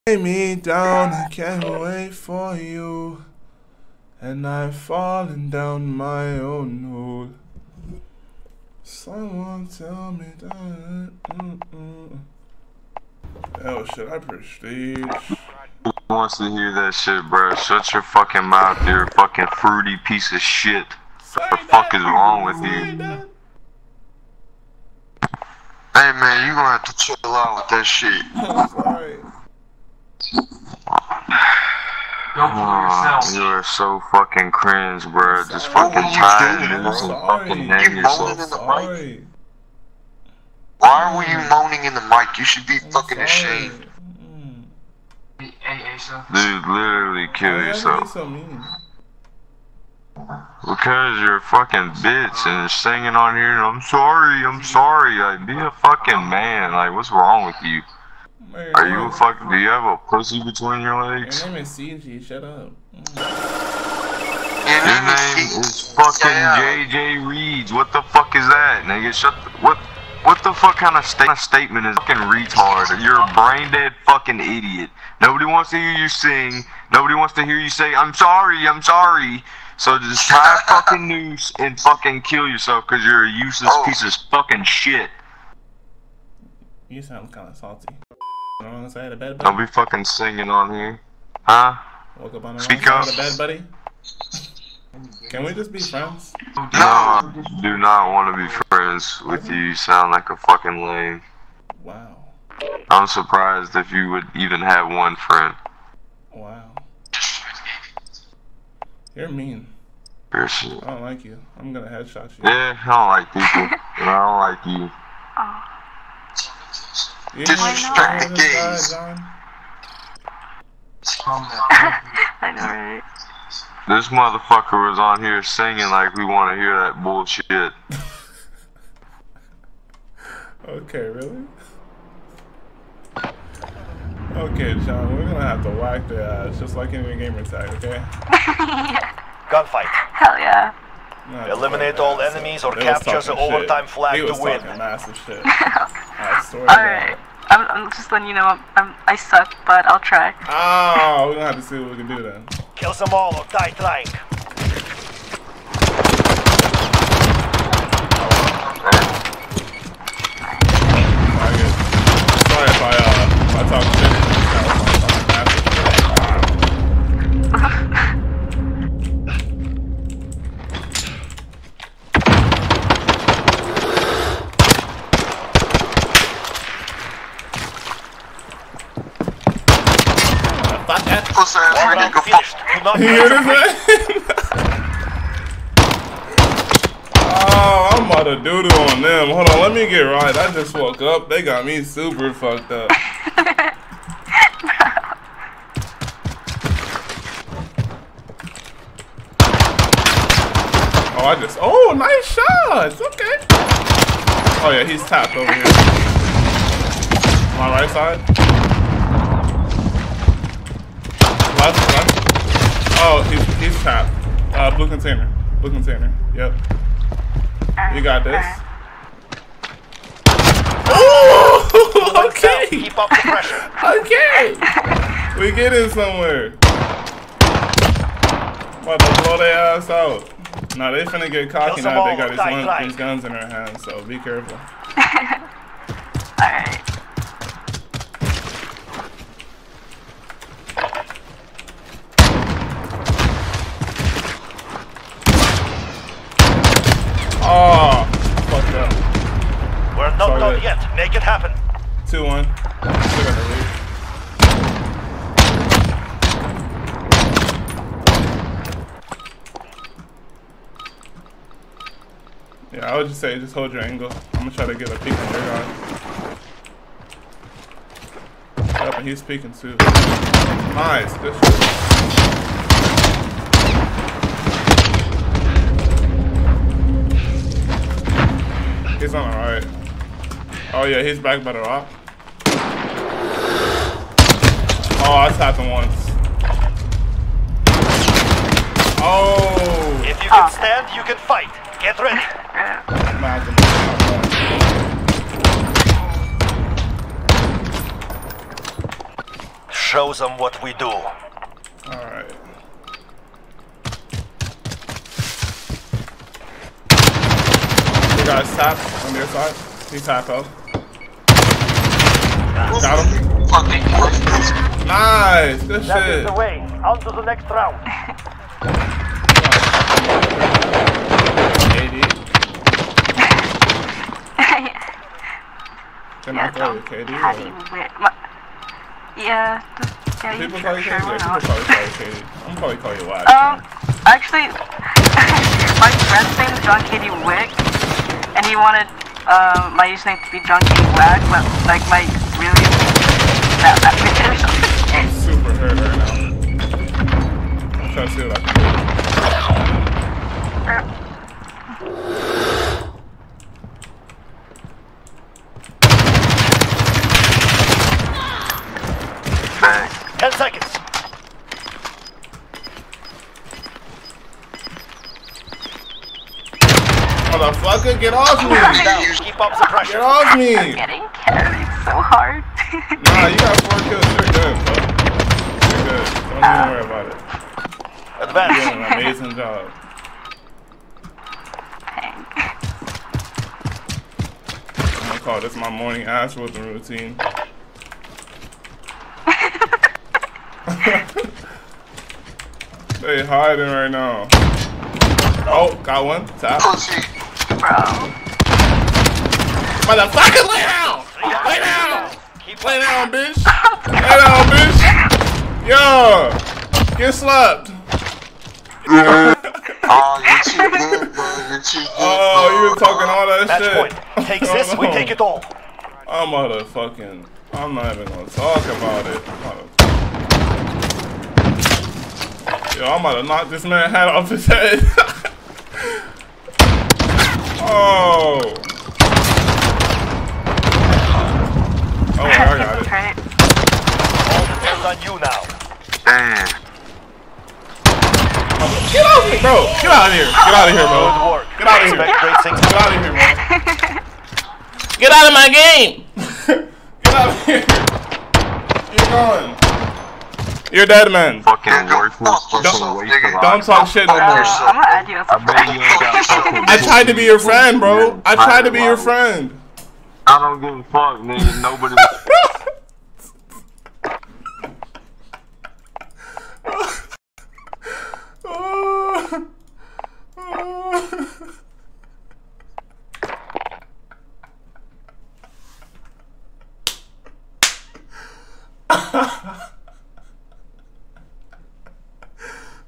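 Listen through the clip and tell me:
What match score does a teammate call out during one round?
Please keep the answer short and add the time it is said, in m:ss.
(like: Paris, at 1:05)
2-1, at 4:12.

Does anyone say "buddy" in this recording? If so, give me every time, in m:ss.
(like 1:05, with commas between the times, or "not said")
1:29, 1:33.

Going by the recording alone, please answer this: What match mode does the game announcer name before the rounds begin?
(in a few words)
Gunfight.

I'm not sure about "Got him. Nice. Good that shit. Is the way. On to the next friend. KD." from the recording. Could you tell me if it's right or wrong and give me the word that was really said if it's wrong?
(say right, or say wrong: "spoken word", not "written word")
wrong: "round", not "friend".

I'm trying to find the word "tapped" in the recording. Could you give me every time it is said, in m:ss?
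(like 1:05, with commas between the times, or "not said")
3:25, 4:45.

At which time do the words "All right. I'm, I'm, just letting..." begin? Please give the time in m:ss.
2:26.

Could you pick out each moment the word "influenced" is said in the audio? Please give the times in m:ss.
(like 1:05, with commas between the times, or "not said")
not said.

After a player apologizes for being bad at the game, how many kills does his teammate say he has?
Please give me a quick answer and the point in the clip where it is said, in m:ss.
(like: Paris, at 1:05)
4, at 6:13.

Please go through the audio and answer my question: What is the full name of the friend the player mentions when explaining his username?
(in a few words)
John Katie Wick.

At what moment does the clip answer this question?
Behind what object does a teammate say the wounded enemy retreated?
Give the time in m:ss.
4:41.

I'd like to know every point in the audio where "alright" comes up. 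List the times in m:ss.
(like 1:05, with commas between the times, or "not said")
3:56, 4:39, 5:01.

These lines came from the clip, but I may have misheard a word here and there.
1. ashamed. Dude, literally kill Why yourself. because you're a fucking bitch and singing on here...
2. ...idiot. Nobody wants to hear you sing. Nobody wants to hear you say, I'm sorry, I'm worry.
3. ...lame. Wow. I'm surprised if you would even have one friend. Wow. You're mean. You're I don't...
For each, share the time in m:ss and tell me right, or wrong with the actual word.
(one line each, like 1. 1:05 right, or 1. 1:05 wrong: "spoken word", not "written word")
1. 0:43 right
2. 1:14 wrong: "sorry", not "worry"
3. 1:40 right.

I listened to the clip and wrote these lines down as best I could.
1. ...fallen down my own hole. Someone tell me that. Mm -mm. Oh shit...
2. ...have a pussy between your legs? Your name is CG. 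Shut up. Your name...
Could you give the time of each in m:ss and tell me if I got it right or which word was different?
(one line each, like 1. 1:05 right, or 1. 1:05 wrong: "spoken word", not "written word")
1. 0:04 right
2. 0:59 right.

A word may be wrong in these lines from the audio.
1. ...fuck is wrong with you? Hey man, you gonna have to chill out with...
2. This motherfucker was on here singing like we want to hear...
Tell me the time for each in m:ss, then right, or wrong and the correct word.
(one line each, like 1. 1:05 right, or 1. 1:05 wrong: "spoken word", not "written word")
1. 0:21 right
2. 2:03 right.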